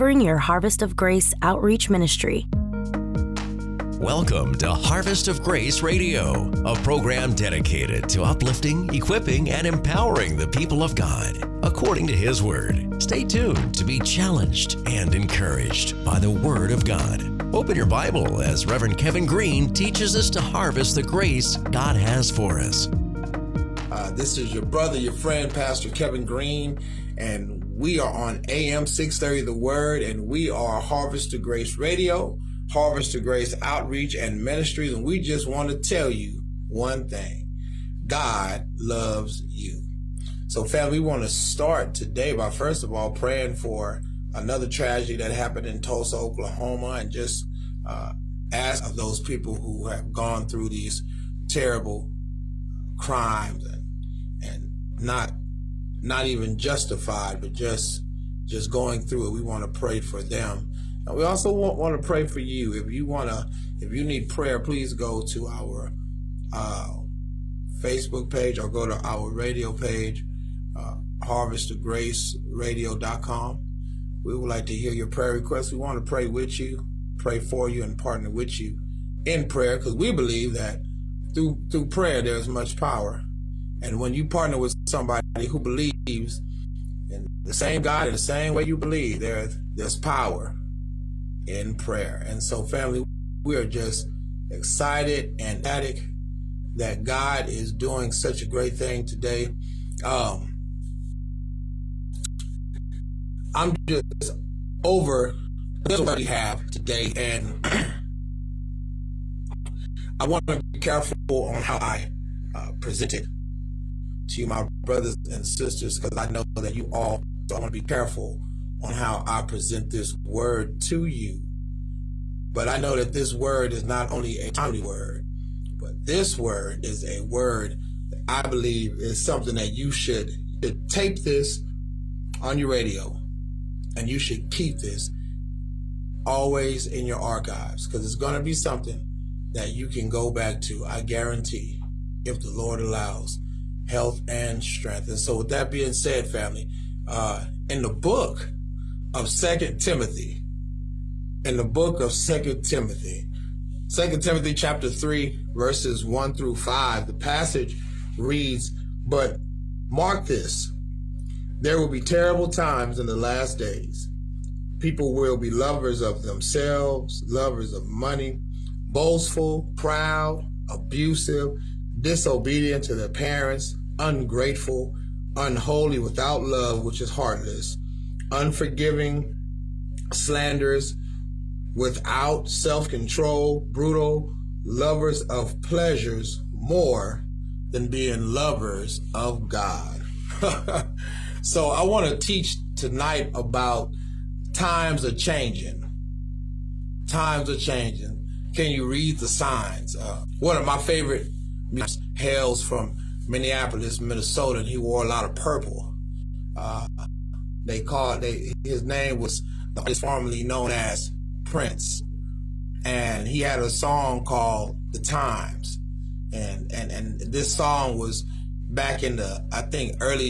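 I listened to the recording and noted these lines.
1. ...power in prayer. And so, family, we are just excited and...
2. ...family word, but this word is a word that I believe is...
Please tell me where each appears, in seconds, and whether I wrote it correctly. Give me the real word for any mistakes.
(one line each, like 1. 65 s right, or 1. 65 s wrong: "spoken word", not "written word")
1. 89 s right
2. 124 s wrong: "timely", not "family".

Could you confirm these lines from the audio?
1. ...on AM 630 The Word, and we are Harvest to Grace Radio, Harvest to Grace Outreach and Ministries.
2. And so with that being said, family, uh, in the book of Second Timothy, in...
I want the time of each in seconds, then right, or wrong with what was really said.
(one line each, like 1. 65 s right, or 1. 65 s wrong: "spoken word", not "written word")
1. 28 s right
2. 145 s right.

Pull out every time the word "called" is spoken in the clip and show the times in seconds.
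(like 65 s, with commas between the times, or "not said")
207 s, 214 s.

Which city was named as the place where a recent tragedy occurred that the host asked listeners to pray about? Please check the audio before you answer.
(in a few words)
Tulsa, Oklahoma.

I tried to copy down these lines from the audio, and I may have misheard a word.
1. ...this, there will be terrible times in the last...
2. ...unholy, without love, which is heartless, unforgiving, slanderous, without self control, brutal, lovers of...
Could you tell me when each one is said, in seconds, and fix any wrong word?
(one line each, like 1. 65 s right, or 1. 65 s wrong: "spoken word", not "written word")
1. 160 s right
2. 175 s right.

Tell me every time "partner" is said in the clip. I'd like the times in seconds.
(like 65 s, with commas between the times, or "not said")
77 s, 84 s.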